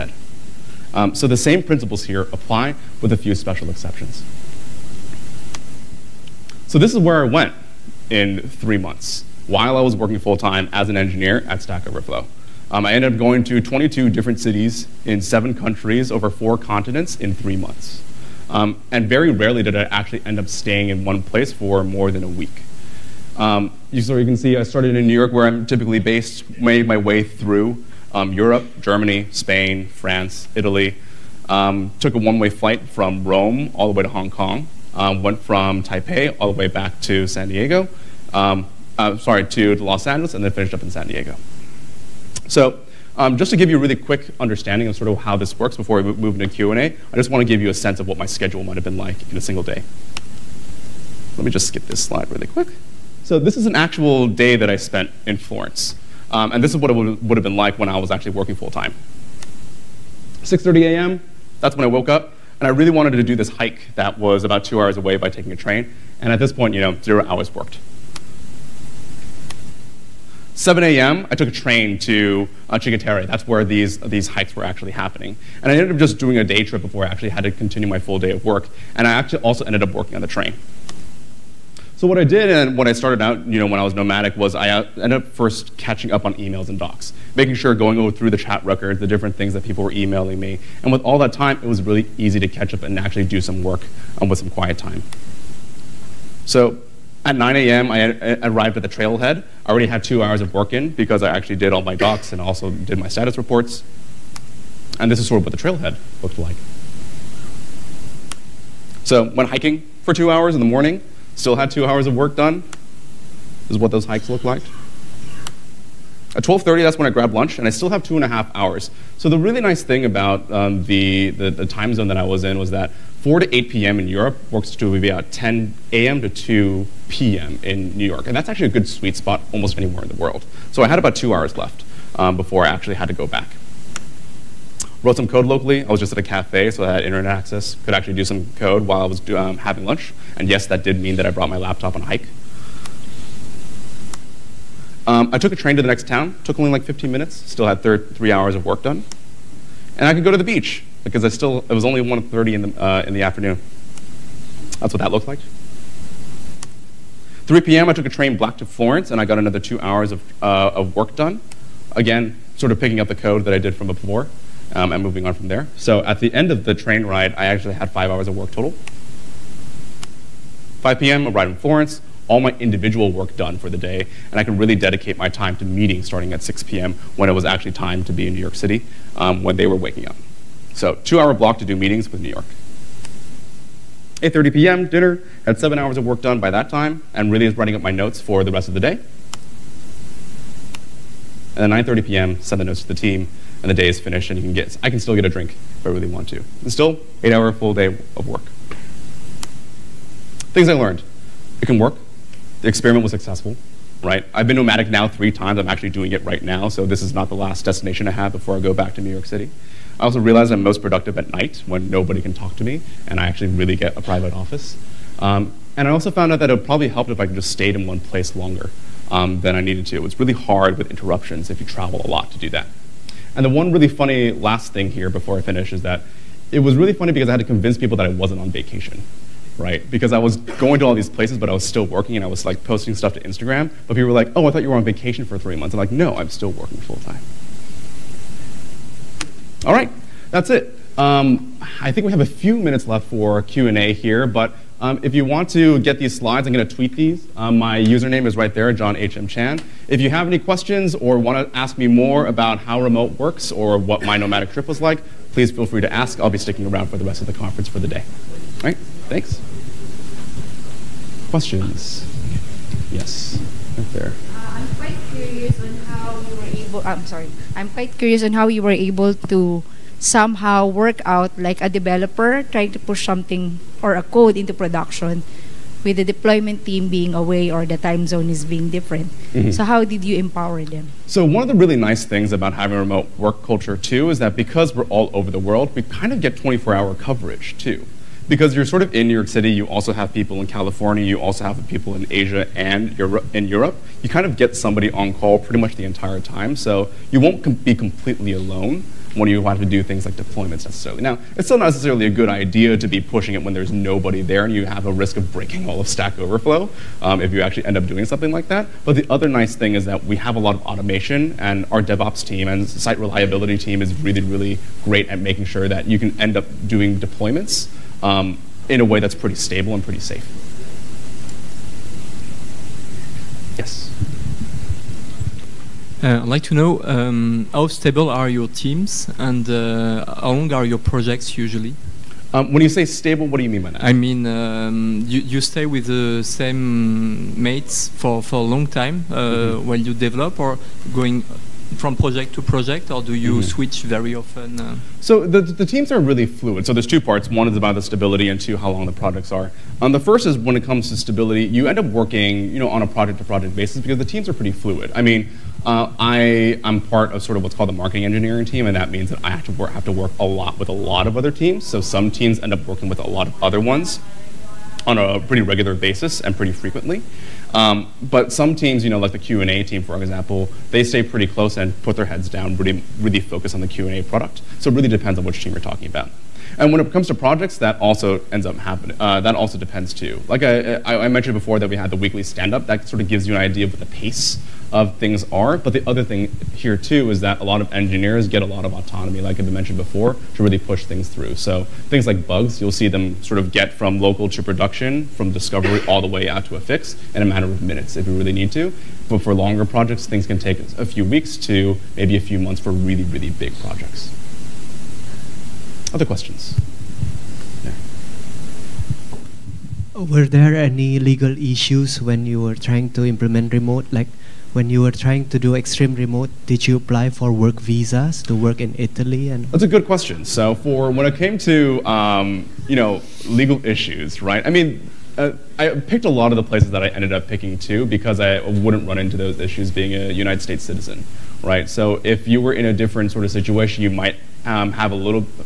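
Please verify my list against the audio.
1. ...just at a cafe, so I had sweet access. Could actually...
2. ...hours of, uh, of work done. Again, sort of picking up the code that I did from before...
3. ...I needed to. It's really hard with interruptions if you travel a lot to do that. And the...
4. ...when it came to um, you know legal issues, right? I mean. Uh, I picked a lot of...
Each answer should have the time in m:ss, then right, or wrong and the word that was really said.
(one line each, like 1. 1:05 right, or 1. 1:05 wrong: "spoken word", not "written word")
1. 2:15 wrong: "internet", not "sweet"
2. 2:39 right
3. 3:39 right
4. 7:00 right.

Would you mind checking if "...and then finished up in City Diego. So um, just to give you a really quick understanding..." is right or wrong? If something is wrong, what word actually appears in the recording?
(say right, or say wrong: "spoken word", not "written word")
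wrong: "San", not "City".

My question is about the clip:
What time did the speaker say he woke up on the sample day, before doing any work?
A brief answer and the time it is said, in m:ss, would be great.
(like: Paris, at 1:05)
6:30 a.m., at 1:00.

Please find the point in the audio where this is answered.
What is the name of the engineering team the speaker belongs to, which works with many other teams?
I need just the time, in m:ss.
5:57.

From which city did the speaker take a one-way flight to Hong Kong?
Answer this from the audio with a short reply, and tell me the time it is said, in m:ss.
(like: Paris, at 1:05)
Rome, at 0:33.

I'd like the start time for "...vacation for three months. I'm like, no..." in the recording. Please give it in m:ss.
3:54.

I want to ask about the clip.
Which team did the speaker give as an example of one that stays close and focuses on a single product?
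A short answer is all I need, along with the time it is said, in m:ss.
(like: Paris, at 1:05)
Q&A team, at 6:09.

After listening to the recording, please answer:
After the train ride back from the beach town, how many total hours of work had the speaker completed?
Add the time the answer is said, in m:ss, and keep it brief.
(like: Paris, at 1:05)
5, at 2:47.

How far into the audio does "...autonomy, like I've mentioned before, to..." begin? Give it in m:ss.
6:28.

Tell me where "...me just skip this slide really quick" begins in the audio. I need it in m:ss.
0:51.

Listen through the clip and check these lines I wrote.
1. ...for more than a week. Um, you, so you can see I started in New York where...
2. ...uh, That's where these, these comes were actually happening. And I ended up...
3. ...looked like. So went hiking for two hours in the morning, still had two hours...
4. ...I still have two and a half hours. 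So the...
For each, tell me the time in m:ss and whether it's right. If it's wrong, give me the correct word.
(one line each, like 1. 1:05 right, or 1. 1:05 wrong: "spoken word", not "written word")
1. 0:21 right
2. 1:12 wrong: "hikes", not "comes"
3. 1:46 right
4. 1:57 right.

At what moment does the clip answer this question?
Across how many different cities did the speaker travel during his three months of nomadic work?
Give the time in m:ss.
0:13.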